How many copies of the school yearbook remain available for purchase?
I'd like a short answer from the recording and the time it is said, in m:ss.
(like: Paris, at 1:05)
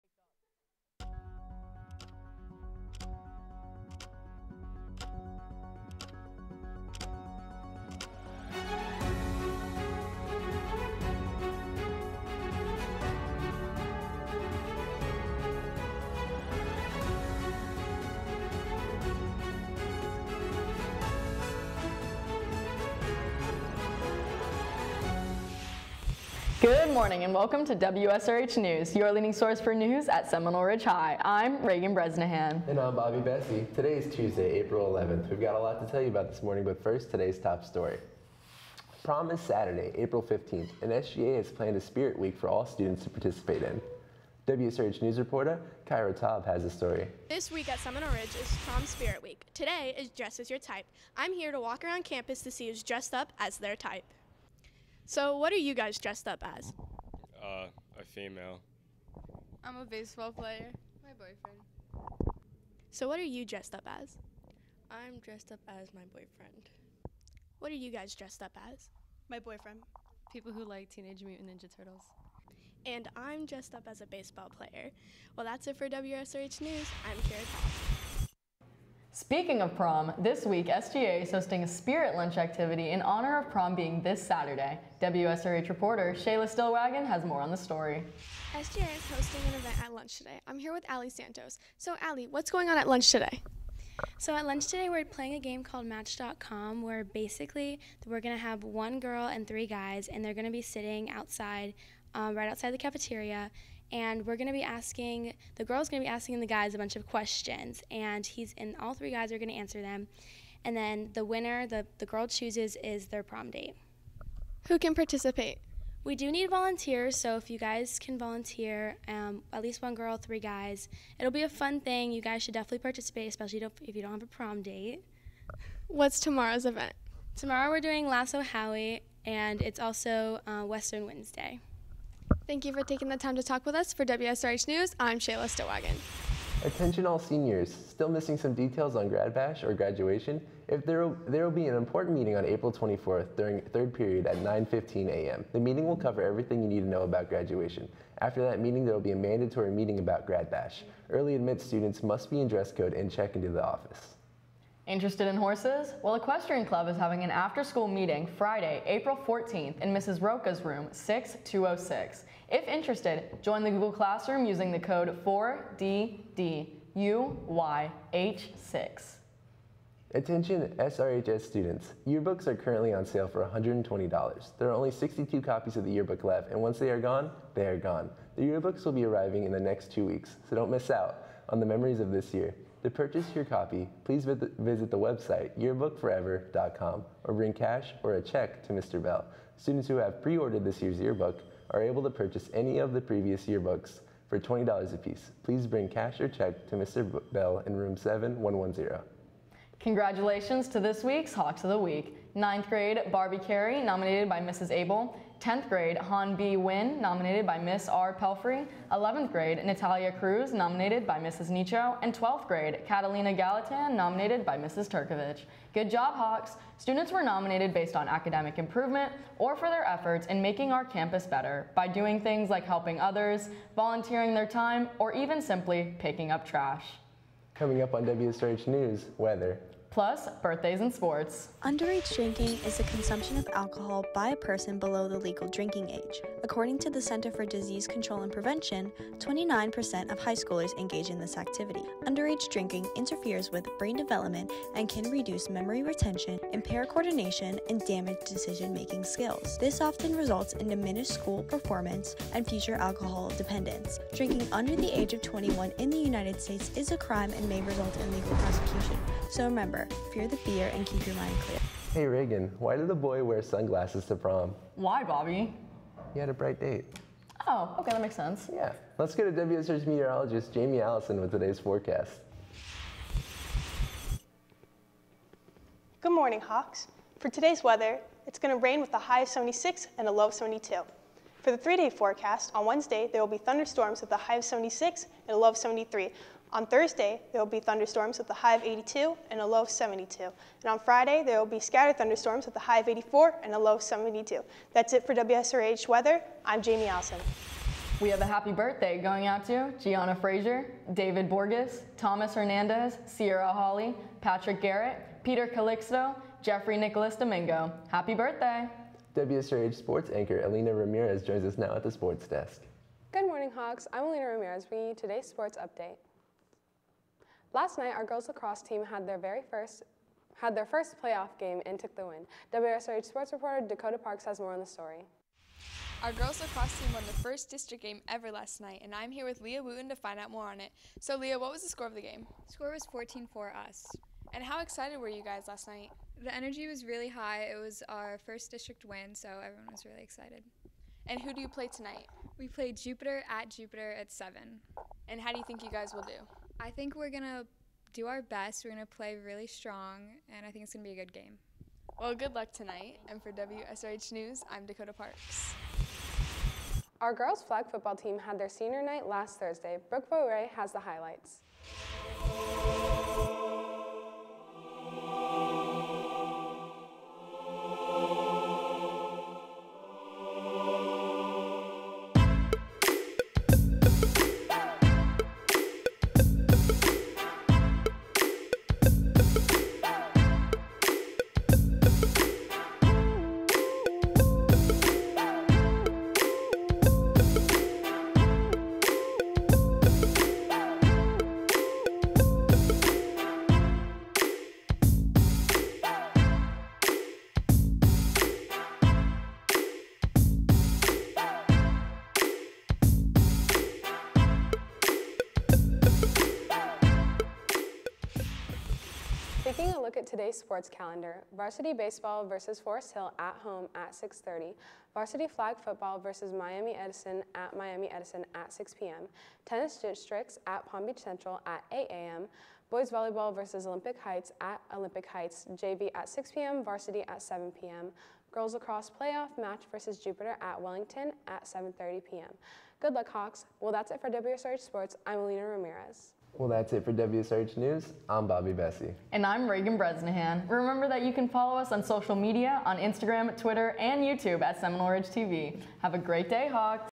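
62, at 2:54.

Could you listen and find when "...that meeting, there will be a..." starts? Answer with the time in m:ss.
2:28.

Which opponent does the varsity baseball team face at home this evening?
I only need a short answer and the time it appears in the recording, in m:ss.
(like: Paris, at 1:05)
Forest Hill, at 6:52.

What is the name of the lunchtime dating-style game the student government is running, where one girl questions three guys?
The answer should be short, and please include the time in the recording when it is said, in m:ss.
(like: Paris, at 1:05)
Match.com, at 1:35.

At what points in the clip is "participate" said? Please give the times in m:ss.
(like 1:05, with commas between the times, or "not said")
0:43, 1:54, 2:02.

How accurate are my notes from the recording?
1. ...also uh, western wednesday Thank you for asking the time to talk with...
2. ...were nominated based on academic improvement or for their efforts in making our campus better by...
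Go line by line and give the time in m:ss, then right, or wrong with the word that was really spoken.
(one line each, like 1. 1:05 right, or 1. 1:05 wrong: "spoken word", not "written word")
1. 2:09 wrong: "taking", not "asking"
2. 3:37 right.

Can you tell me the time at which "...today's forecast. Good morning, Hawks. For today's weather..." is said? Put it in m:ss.
4:31.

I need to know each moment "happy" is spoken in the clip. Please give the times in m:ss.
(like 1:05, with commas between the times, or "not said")
4:58, 5:07.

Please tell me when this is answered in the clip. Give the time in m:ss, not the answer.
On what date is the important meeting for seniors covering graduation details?
2:22.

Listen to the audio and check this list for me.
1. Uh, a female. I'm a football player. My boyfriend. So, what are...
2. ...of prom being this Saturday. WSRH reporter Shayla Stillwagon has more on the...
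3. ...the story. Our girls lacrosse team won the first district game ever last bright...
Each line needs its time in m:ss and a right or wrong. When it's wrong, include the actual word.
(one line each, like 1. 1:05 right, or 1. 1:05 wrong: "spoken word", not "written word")
1. 0:57 wrong: "baseball", not "football"
2. 1:23 right
3. 5:24 wrong: "night", not "bright".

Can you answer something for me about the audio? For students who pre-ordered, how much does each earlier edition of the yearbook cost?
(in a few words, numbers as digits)
$20.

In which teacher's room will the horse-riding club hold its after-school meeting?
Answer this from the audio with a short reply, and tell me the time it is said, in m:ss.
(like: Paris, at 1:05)
Mrs. Roca, at 2:39.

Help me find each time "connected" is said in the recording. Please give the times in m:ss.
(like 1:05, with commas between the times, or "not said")
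not said.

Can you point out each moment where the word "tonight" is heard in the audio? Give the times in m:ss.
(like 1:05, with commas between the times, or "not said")
5:41, 5:52.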